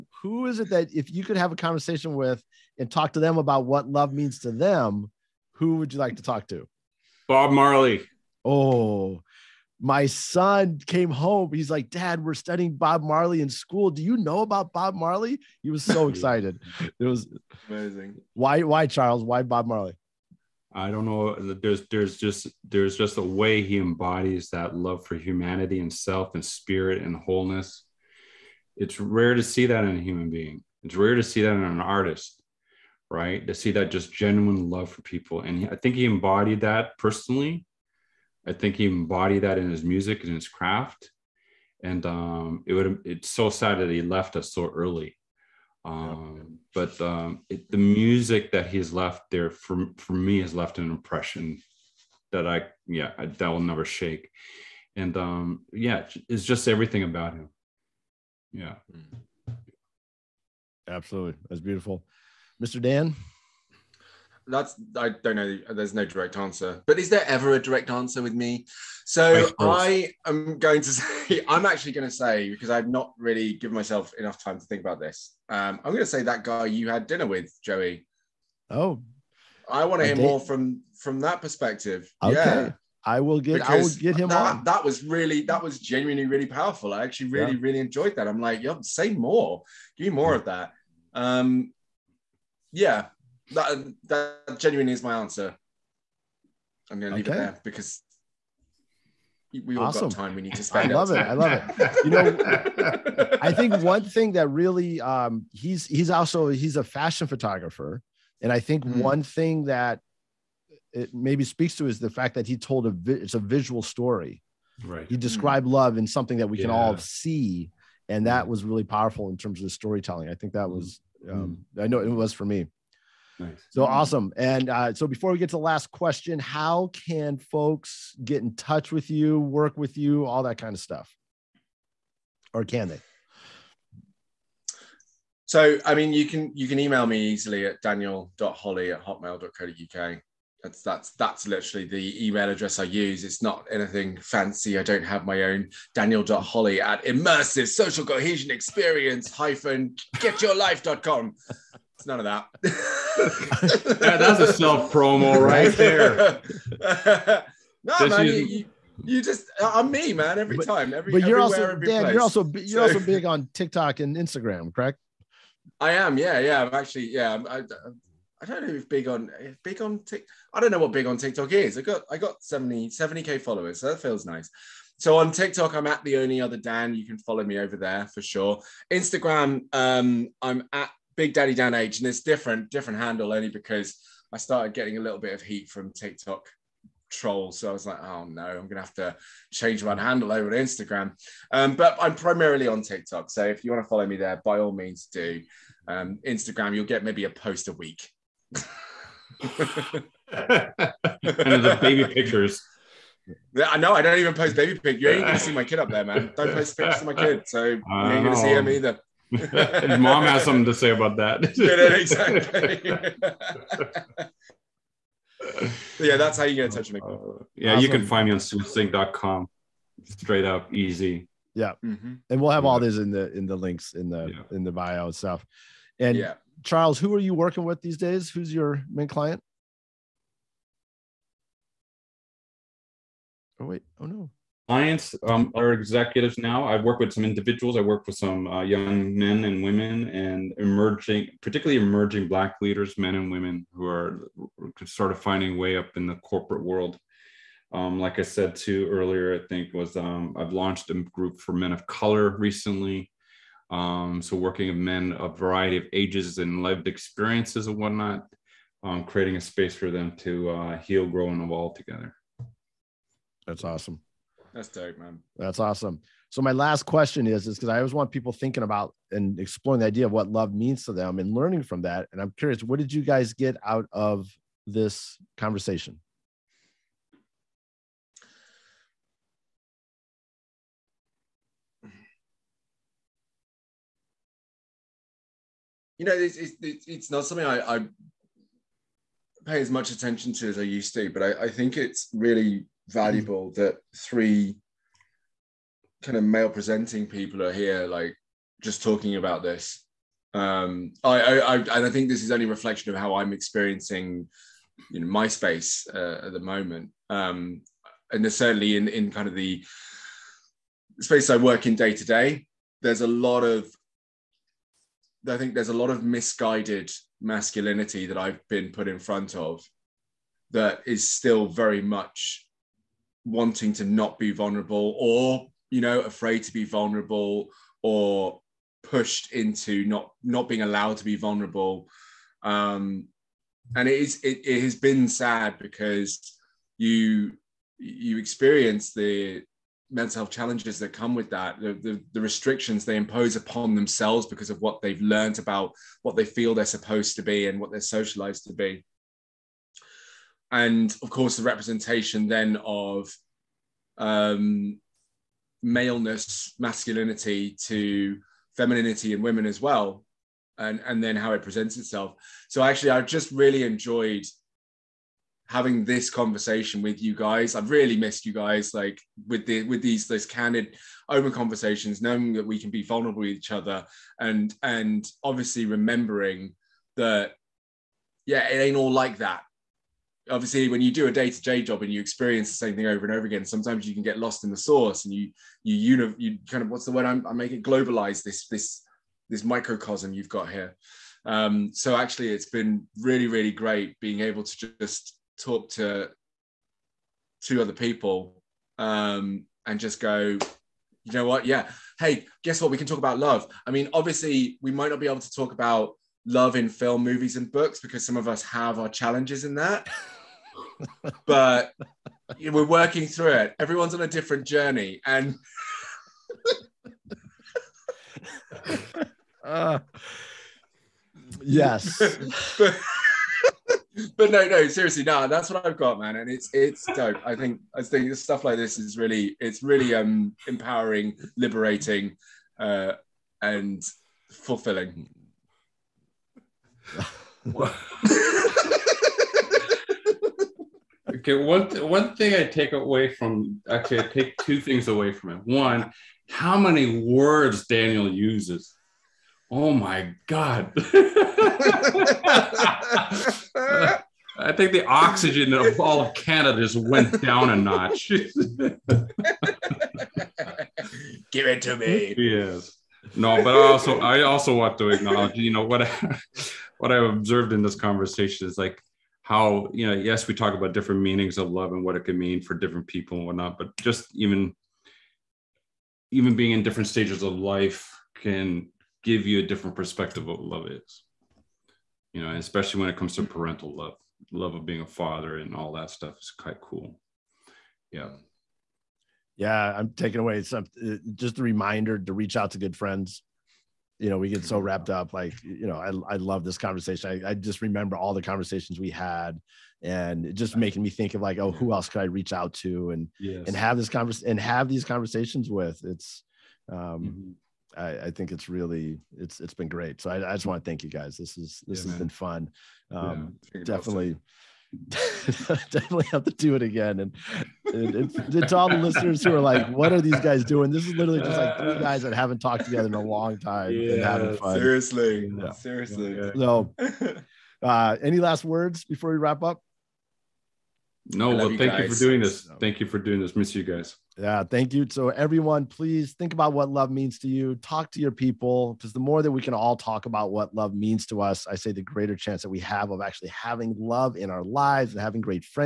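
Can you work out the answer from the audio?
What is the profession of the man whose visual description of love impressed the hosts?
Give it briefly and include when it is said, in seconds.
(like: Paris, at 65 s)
Fashion photographer, at 106 s.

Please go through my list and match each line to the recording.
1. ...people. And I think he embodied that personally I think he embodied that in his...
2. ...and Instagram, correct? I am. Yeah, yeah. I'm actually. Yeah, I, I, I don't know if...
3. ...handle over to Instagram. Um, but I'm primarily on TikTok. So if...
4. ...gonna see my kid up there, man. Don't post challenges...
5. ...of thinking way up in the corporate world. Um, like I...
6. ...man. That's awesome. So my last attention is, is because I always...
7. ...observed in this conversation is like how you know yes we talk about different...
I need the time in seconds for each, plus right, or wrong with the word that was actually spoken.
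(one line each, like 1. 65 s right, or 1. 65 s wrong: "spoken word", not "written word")
1. 35 s right
2. 163 s right
3. 189 s right
4. 205 s wrong: "pictures", not "challenges"
5. 245 s wrong: "finding", not "thinking"
6. 264 s wrong: "question", not "attention"
7. 467 s right.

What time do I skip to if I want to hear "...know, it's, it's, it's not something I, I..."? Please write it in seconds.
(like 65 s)
286 s.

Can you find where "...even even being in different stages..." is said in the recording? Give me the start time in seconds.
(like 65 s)
474 s.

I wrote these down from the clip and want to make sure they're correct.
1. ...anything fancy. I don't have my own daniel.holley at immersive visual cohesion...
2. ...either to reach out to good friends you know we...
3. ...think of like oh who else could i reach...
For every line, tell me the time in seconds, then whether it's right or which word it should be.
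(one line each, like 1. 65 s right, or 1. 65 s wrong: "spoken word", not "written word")
1. 143 s wrong: "social", not "visual"
2. 491 s wrong: "reminder", not "either"
3. 500 s right.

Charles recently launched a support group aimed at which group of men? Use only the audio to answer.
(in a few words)
Men of color.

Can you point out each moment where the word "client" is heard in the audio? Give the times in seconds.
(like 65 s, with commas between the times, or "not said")
229 s, 234 s.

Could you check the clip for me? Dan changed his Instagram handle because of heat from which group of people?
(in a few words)
TikTok trolls.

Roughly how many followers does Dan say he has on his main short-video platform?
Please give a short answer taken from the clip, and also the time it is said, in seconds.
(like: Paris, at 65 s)
70k, at 172 s.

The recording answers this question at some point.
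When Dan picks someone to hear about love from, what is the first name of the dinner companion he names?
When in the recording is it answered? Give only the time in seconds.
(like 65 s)
77 s.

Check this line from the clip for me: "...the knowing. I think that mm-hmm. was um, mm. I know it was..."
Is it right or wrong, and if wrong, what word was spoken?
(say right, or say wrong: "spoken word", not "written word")
wrong: "storytelling", not "knowing".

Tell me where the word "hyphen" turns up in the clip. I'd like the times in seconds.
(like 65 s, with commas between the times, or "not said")
149 s.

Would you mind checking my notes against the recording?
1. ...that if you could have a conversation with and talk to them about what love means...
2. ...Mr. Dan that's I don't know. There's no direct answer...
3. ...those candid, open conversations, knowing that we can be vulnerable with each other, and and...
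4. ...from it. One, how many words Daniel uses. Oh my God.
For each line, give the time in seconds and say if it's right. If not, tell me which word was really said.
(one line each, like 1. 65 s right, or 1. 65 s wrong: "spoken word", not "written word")
1. 0 s right
2. 62 s right
3. 370 s right
4. 445 s right.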